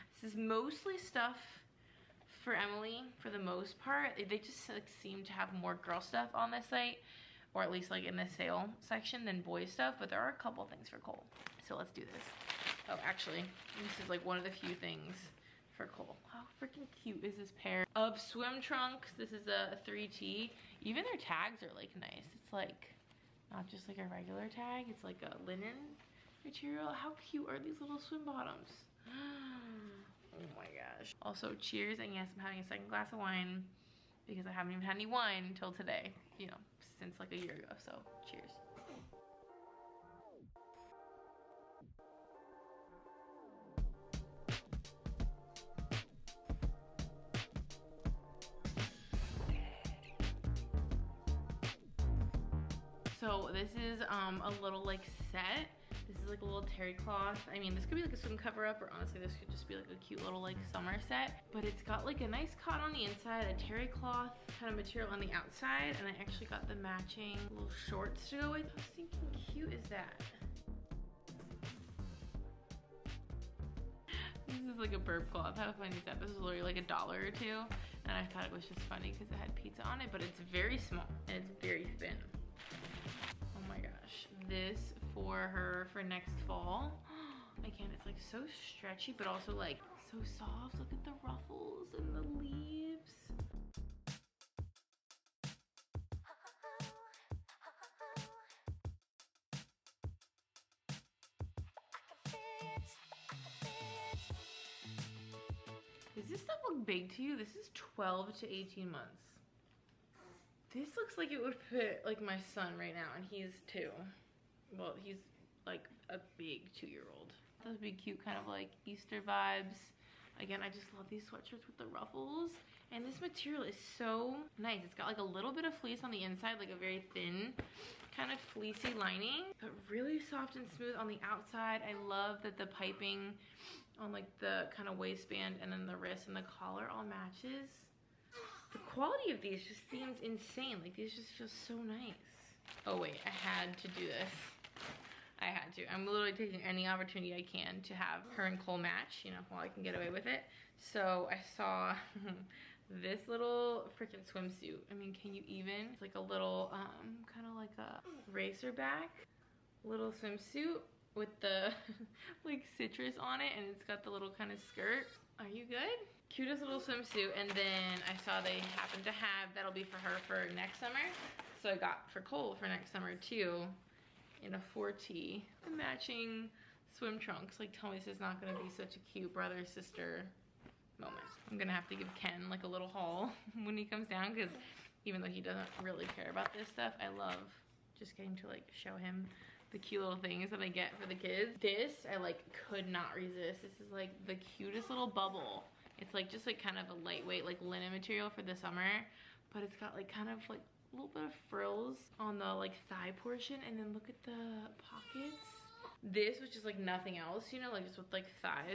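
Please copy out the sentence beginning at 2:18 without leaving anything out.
The quality of these just seems insane.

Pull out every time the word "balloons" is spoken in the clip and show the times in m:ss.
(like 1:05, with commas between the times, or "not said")
not said.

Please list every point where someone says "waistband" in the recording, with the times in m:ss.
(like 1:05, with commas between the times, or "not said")
2:14.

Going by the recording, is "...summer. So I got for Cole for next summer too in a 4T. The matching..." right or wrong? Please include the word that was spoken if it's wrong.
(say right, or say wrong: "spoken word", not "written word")
right.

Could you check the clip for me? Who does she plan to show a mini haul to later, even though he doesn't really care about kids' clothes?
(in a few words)
Ken.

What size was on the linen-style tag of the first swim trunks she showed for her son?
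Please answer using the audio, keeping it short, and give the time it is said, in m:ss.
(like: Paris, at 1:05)
3T, at 0:19.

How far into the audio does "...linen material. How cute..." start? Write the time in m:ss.
0:25.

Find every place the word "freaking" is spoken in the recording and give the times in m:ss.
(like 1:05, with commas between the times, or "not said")
0:16, 2:33.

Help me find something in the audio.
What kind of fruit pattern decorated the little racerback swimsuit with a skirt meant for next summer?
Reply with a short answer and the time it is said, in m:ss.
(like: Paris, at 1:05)
Citrus, at 2:42.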